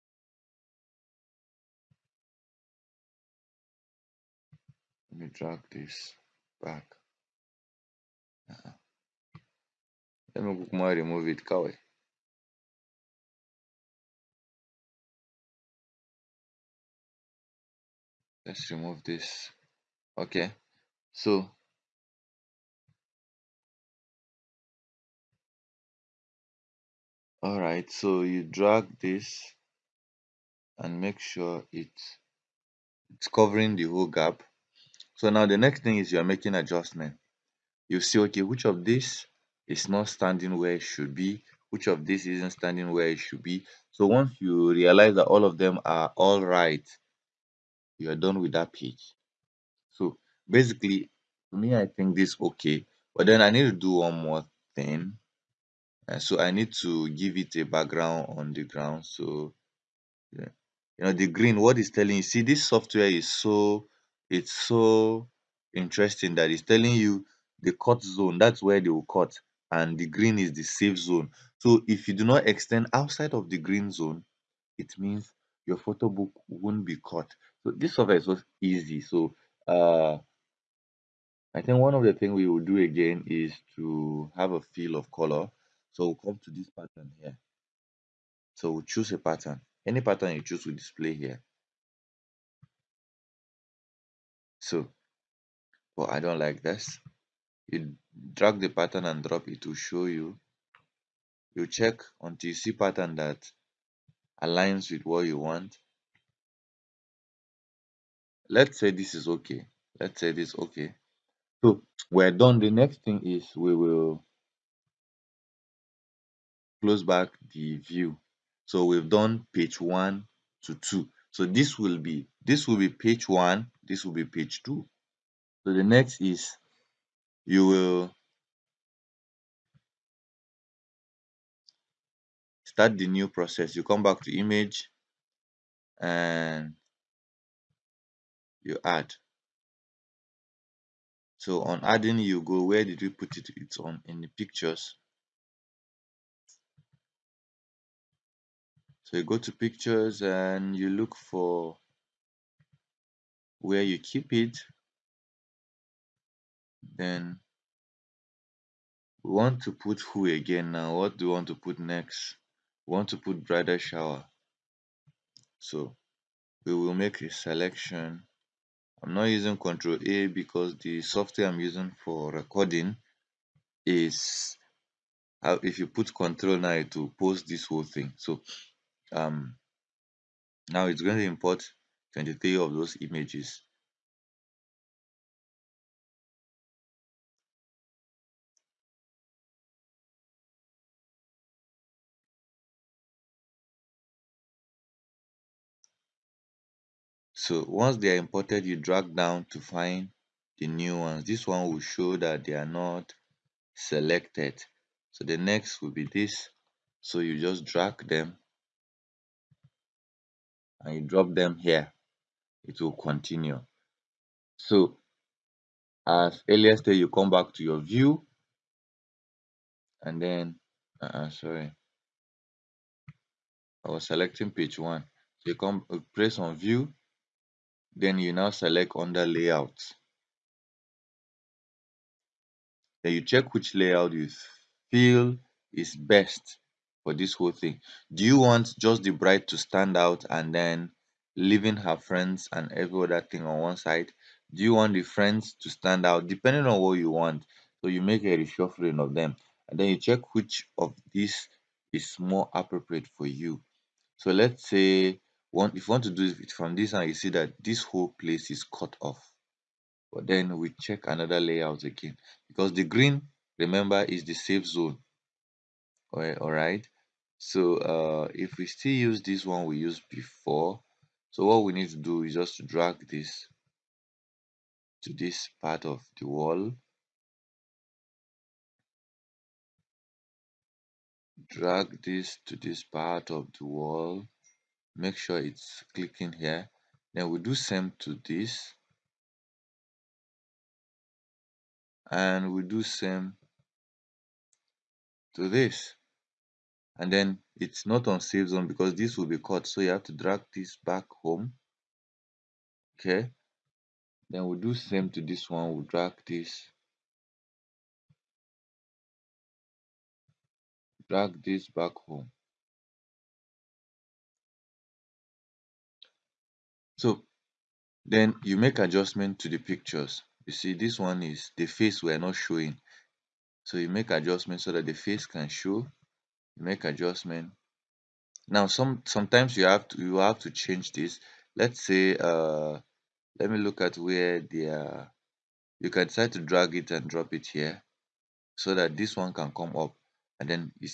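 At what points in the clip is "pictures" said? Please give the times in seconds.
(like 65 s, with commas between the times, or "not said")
144 s, 149 s, 319 s.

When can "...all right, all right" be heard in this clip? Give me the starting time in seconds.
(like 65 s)
266 s.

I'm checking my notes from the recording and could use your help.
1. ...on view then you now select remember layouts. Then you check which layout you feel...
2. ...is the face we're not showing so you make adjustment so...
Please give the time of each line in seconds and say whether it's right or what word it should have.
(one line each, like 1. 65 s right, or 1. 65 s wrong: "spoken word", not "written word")
1. 226 s wrong: "under", not "remember"
2. 321 s right.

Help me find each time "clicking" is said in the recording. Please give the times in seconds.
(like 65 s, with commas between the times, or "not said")
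285 s.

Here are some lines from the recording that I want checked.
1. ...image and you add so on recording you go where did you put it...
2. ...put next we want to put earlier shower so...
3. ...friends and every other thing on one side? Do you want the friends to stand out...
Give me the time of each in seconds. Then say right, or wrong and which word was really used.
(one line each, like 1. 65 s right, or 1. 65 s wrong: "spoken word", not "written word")
1. 134 s wrong: "adding", not "recording"
2. 161 s wrong: "brighter", not "earlier"
3. 241 s right.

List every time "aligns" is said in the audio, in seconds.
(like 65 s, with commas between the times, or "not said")
104 s.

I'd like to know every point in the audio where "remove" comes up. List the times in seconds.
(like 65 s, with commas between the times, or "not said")
11 s, 18 s.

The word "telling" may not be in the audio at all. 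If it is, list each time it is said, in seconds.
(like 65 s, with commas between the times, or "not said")
61 s, 66 s.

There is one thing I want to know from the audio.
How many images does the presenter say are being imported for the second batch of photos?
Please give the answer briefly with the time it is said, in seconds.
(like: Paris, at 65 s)
23, at 182 s.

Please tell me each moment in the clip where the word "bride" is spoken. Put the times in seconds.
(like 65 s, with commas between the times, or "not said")
239 s.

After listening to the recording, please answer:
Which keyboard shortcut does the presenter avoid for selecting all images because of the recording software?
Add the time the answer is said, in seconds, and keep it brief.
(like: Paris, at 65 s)
Control A, at 169 s.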